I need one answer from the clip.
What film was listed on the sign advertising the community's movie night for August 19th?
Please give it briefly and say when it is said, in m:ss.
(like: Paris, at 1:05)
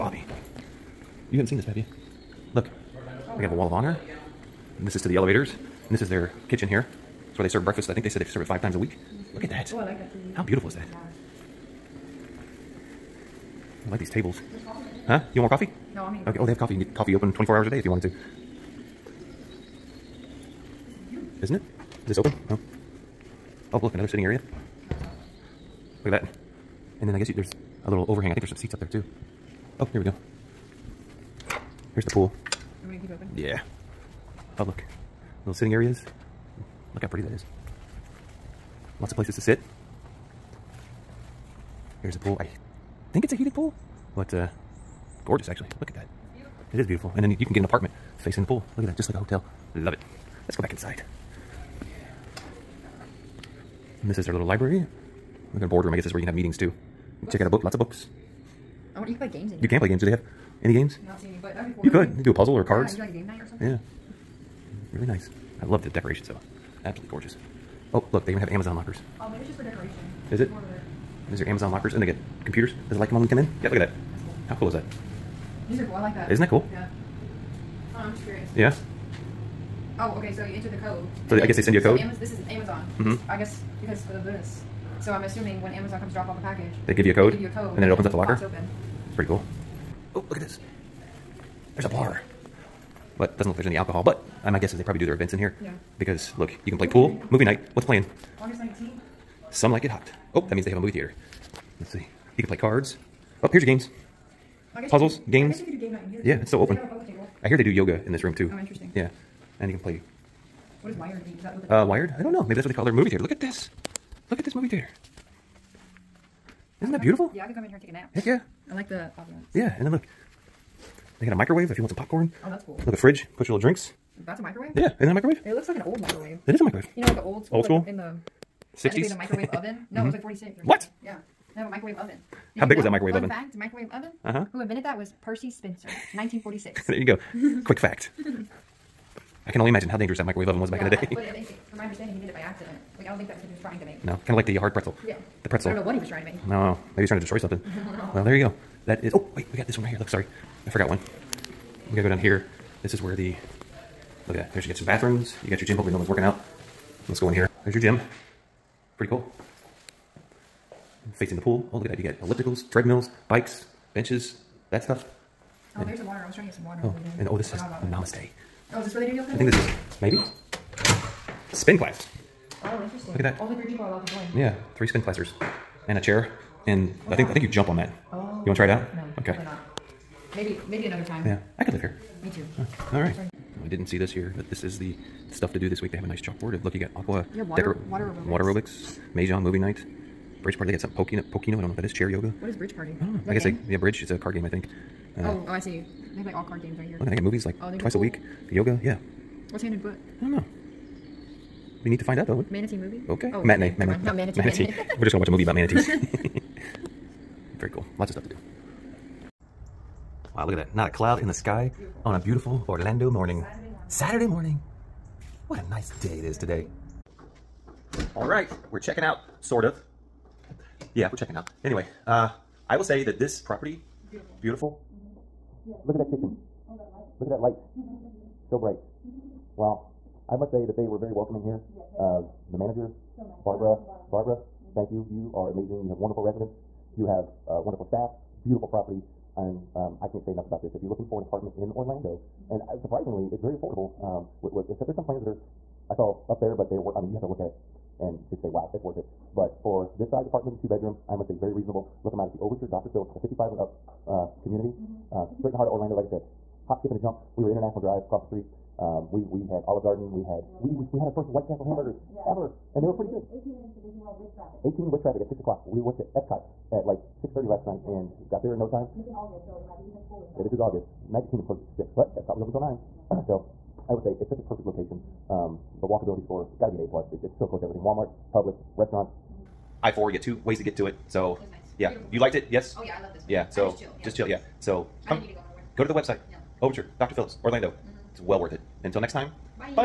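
Some Like It Hot, at 1:39.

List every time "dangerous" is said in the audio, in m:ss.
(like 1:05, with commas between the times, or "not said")
2:19.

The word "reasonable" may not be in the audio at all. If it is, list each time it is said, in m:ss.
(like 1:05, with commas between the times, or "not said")
4:11.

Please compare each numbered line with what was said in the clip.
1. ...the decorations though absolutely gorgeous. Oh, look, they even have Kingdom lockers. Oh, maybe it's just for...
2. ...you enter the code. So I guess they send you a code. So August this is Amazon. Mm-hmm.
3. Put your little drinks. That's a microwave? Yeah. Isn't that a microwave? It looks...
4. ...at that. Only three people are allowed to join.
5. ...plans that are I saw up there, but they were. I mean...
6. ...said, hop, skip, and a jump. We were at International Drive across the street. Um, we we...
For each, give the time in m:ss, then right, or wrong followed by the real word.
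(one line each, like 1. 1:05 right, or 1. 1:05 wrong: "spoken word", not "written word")
1. 1:05 wrong: "Amazon", not "Kingdom"
2. 1:20 wrong: "Amaz", not "August"
3. 2:03 right
4. 2:53 right
5. 4:05 right
6. 4:16 right.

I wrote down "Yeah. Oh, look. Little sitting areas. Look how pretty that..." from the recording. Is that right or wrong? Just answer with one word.
right.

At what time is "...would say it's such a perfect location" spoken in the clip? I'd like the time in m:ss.
4:33.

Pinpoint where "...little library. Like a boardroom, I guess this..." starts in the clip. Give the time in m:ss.
0:54.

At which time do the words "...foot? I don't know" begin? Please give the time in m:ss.
3:19.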